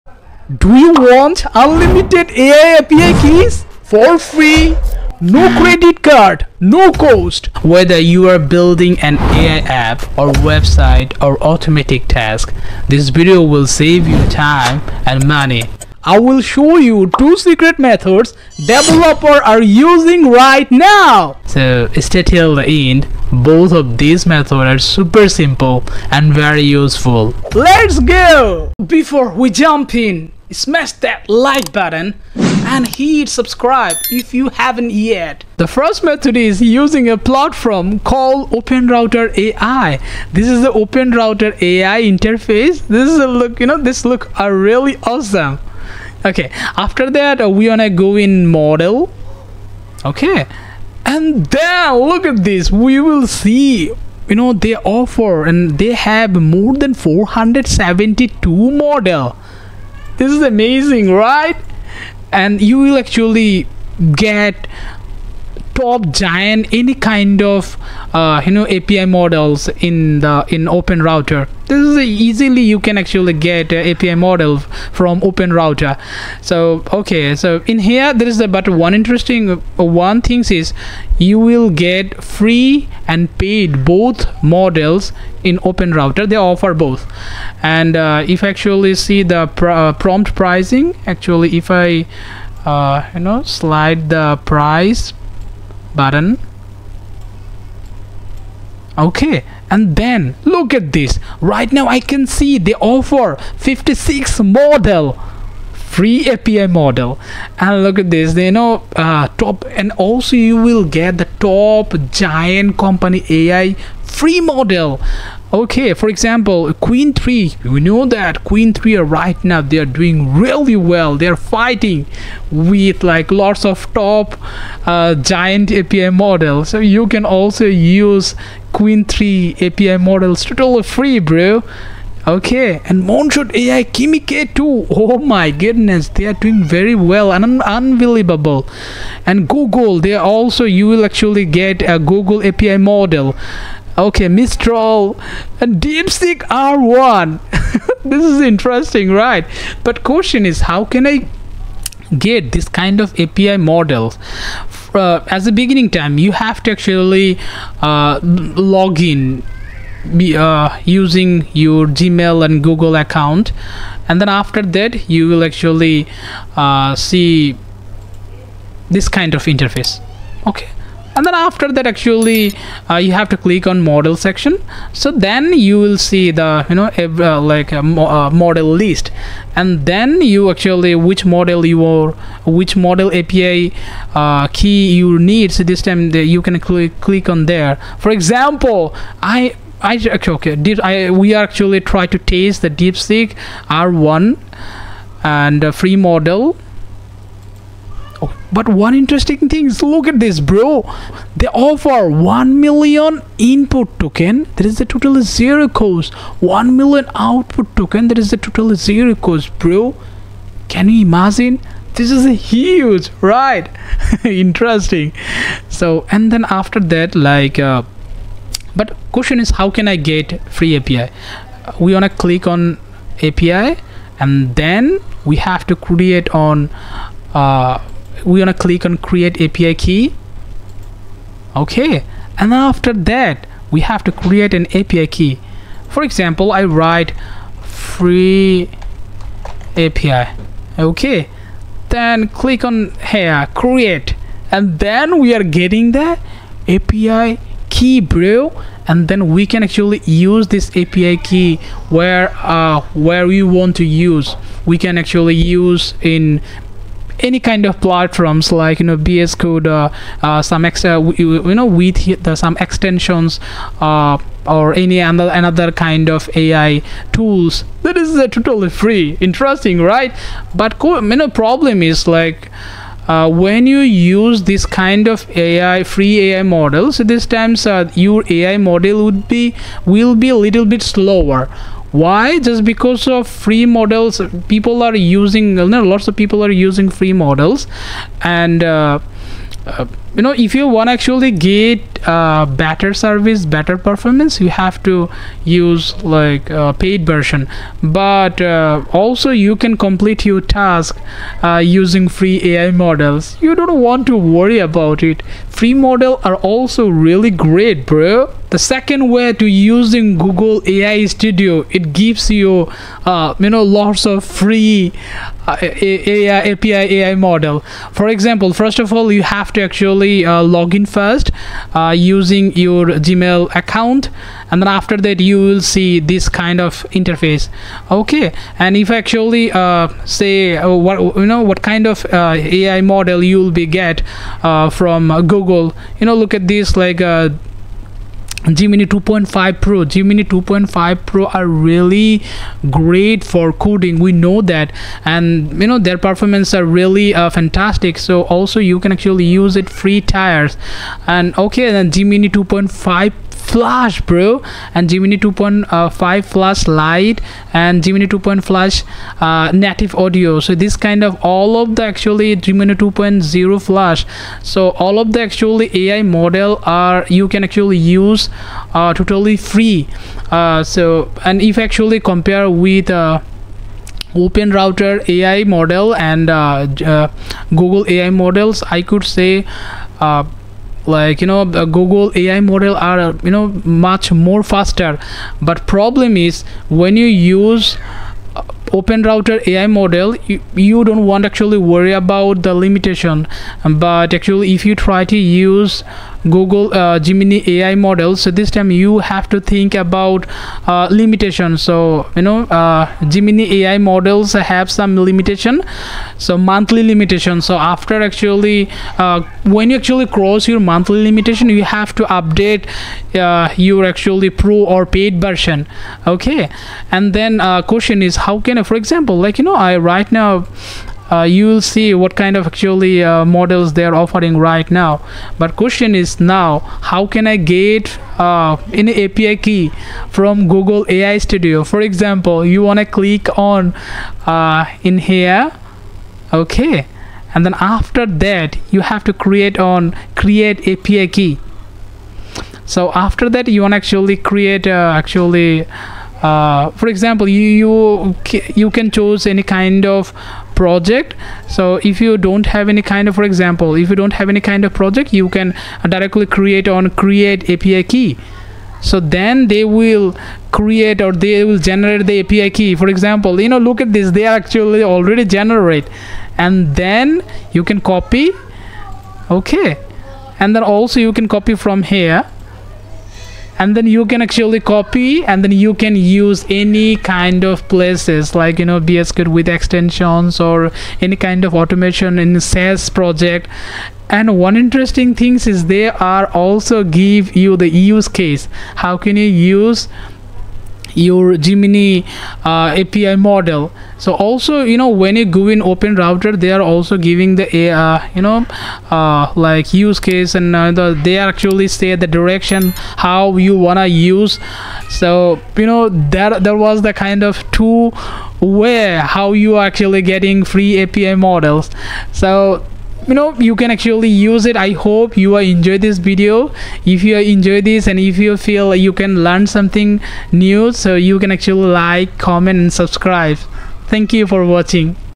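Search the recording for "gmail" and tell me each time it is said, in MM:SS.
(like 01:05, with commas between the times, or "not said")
02:41, 05:23.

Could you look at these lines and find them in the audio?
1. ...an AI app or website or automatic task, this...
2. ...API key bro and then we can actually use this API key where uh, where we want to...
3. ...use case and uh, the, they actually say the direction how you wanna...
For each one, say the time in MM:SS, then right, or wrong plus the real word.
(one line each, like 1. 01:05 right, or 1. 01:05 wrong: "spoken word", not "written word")
1. 00:08 right
2. 04:06 right
3. 08:19 right.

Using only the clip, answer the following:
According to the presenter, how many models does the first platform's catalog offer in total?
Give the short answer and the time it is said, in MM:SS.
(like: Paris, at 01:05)
472, at 00:56.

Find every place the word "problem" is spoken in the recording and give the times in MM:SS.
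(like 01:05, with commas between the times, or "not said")
04:31, 06:25.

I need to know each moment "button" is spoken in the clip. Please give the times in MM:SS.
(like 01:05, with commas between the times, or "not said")
00:31, 01:35.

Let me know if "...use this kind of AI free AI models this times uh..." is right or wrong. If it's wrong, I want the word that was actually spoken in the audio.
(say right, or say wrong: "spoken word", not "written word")
right.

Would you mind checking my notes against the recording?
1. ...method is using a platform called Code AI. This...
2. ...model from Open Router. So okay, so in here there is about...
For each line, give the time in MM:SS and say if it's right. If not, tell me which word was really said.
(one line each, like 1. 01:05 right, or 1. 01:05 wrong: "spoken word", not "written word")
1. 00:36 wrong: "OpenRouter", not "Code"
2. 01:14 right.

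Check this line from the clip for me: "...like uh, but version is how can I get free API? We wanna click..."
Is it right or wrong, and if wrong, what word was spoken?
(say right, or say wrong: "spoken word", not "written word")
wrong: "question", not "version".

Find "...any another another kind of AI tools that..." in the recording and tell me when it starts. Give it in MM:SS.
04:24.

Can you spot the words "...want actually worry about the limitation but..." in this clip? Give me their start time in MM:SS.
06:31.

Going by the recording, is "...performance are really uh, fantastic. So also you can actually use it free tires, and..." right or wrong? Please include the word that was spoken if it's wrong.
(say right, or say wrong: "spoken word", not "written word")
right.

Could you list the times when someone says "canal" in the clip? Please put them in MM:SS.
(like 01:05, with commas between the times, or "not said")
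not said.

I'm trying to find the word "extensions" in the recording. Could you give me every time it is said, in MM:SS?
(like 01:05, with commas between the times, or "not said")
04:22, 07:59.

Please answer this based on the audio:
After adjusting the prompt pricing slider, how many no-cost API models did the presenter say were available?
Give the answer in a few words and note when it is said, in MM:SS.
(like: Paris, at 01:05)
56, at 01:43.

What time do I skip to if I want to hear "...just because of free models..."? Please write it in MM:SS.
04:42.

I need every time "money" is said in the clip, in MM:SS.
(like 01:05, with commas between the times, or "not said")
00:15.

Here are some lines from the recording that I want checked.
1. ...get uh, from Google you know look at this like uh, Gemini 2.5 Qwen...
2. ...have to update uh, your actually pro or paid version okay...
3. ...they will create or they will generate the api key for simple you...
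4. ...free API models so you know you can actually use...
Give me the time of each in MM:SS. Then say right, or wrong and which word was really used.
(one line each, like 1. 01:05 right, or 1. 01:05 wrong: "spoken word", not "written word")
1. 05:33 wrong: "Pro", not "Qwen"
2. 06:51 right
3. 07:39 wrong: "example", not "simple"
4. 08:30 right.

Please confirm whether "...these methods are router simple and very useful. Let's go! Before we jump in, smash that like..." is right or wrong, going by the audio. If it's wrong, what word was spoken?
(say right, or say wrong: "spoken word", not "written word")
wrong: "super", not "router".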